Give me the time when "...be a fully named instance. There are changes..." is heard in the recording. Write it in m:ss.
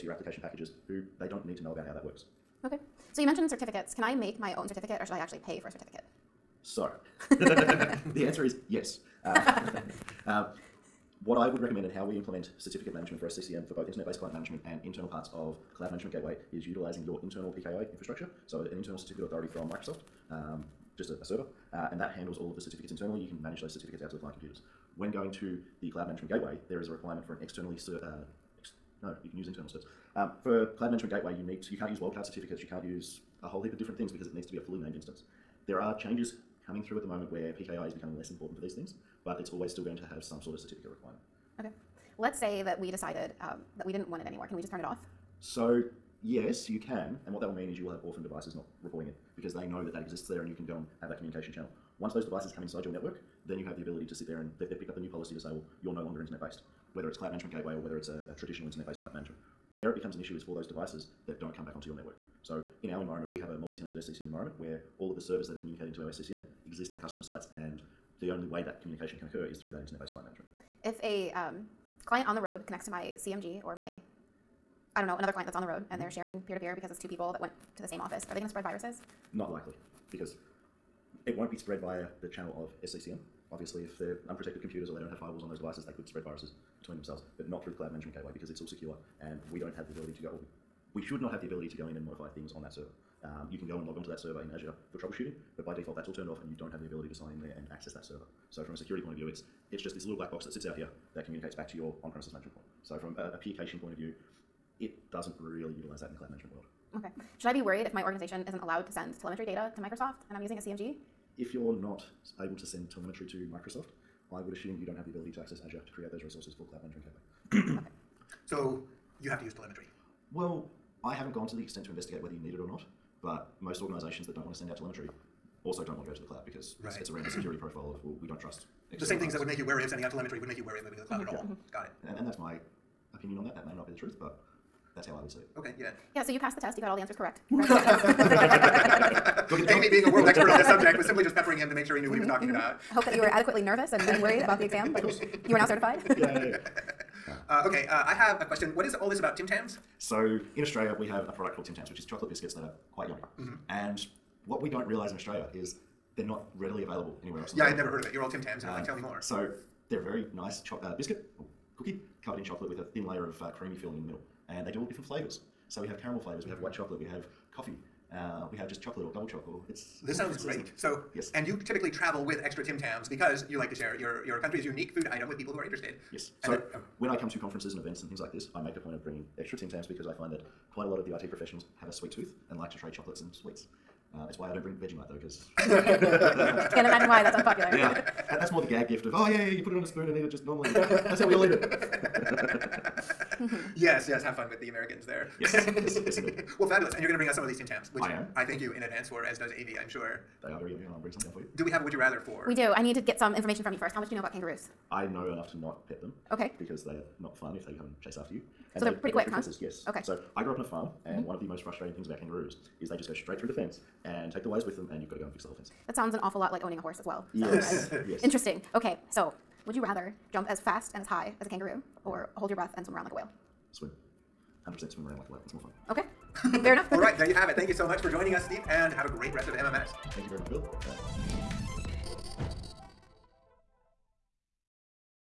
0:34.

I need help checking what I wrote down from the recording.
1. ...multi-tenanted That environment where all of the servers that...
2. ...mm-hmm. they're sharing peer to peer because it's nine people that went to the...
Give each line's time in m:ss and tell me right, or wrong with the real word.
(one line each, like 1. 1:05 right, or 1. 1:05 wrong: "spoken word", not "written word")
1. 1:03 wrong: "SCCM", not "That"
2. 1:15 wrong: "two", not "nine".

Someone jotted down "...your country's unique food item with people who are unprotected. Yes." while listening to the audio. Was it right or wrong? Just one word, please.
wrong.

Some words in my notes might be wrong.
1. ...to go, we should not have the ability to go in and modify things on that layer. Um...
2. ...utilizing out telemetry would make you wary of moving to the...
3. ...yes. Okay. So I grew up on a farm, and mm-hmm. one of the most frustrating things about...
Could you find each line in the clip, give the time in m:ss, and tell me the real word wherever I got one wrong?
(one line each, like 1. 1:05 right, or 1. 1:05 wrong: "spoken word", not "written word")
1. 1:30 wrong: "server", not "layer"
2. 2:09 wrong: "sending", not "utilizing"
3. 3:29 right.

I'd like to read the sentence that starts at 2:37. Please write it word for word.
yeah, I had never heard of it.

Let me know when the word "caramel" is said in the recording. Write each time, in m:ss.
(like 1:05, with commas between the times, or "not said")
2:46.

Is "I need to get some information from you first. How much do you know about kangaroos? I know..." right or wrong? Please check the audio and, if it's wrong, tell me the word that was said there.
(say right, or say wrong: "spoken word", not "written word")
right.